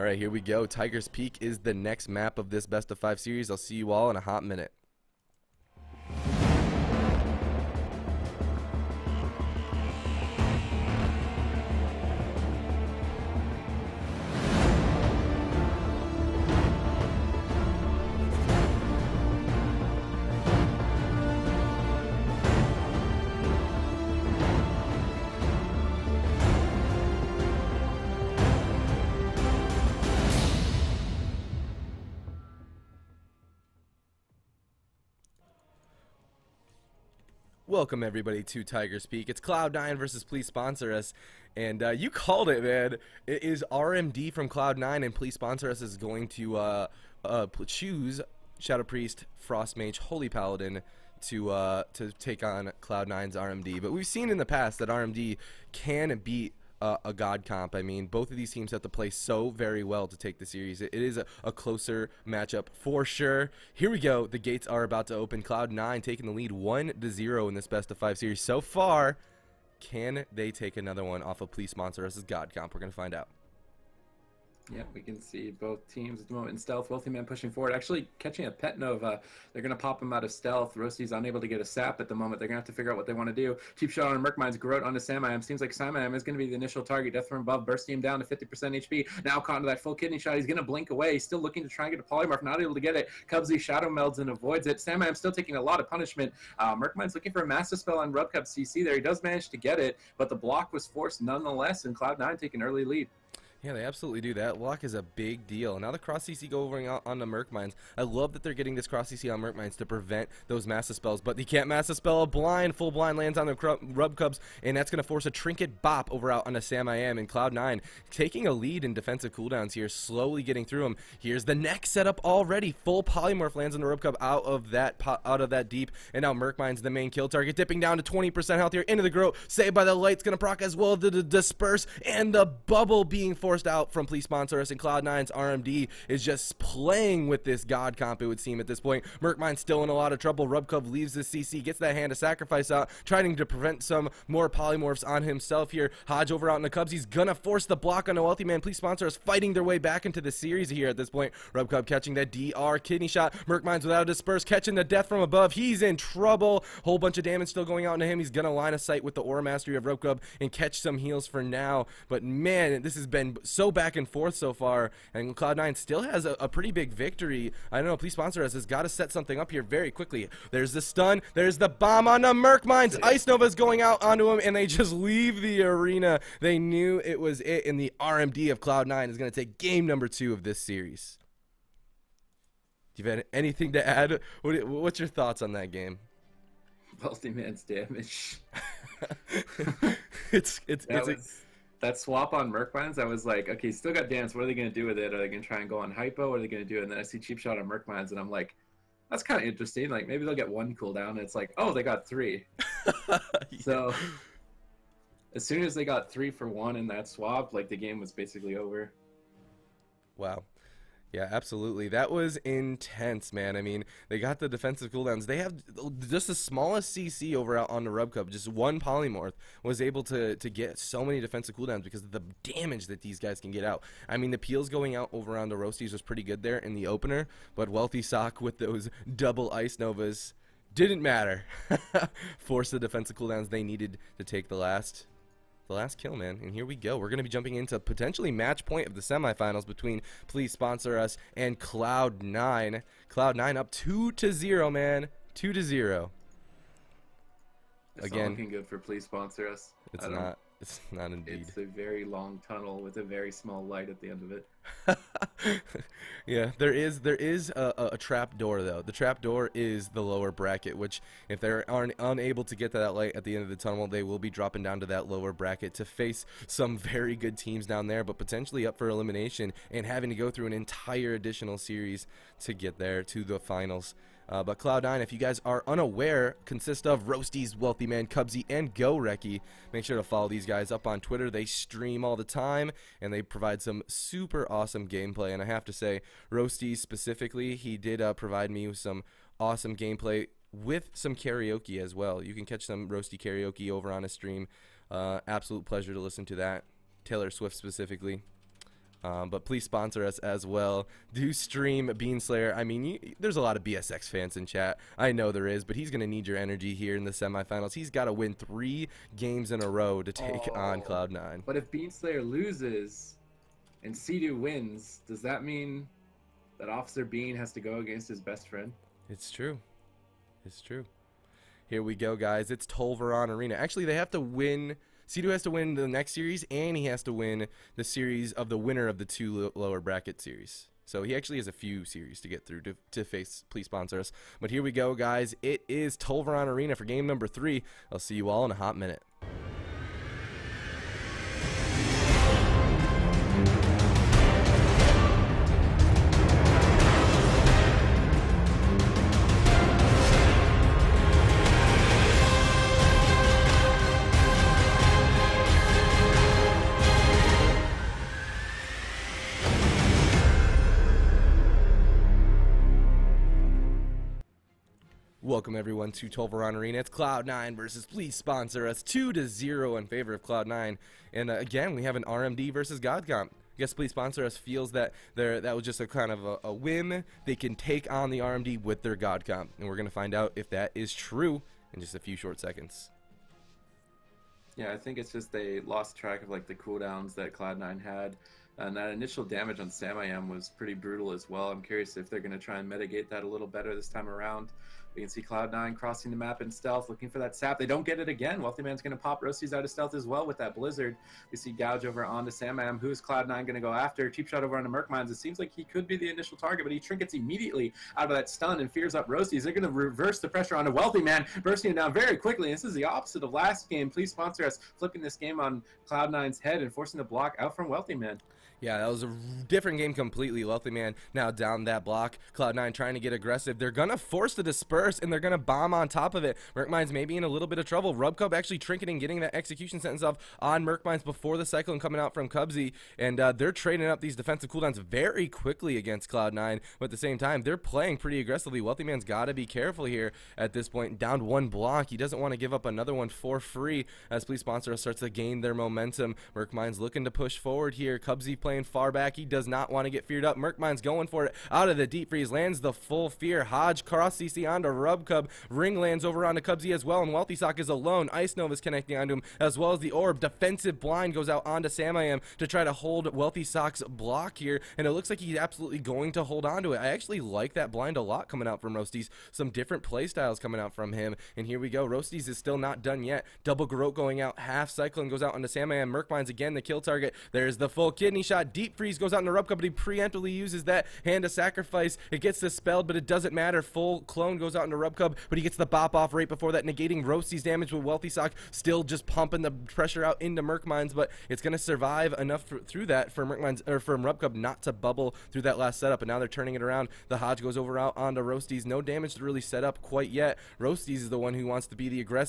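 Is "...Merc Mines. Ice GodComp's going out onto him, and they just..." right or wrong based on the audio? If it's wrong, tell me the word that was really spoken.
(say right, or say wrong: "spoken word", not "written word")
wrong: "Nova", not "GodComp".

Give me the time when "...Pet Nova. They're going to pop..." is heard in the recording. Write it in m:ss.
1:18.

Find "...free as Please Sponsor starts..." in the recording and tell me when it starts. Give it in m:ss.
7:23.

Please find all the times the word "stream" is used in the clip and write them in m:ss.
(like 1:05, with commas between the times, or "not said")
4:41, 4:54, 5:01.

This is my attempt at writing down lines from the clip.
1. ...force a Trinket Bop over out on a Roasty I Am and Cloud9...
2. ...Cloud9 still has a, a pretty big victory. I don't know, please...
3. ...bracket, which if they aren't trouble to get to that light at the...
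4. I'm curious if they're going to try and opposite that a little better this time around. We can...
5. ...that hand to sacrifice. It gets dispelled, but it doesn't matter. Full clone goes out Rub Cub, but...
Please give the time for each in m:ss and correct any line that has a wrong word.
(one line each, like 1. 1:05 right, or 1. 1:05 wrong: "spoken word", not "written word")
1. 1:55 wrong: "Sam", not "Roasty"
2. 2:45 right
3. 4:20 wrong: "unable", not "trouble"
4. 6:31 wrong: "mitigate", not "opposite"
5. 8:00 right.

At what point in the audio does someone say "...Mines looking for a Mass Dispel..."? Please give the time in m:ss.
1:36.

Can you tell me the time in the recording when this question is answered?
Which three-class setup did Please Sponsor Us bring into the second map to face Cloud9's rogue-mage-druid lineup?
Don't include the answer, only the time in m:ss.
0:48.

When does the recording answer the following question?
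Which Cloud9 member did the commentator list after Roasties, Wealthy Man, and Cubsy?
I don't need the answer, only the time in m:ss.
4:38.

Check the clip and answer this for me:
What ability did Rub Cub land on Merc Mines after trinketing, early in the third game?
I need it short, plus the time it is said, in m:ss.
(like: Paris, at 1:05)
Execution Sentence, at 7:09.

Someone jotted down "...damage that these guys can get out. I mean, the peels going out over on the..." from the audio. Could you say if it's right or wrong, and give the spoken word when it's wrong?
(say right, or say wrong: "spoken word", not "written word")
right.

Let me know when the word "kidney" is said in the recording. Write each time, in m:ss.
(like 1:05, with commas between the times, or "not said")
1:29, 2:32, 7:57.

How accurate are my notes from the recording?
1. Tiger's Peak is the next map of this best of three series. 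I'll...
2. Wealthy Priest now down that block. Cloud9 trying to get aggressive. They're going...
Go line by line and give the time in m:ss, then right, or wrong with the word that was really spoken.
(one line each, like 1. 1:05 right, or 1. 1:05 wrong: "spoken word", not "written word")
1. 0:00 wrong: "five", not "three"
2. 7:00 wrong: "Man", not "Priest".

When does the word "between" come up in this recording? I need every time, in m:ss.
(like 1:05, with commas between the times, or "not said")
3:59.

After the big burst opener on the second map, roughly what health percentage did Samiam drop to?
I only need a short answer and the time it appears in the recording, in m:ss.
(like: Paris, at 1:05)
50%, at 1:28.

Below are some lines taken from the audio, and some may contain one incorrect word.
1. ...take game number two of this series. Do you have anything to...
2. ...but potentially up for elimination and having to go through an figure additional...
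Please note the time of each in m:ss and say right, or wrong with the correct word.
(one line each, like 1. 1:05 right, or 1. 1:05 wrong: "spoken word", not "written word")
1. 2:59 right
2. 4:28 wrong: "entire", not "figure".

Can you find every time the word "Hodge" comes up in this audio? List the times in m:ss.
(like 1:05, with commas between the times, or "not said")
2:26, 7:33, 8:17.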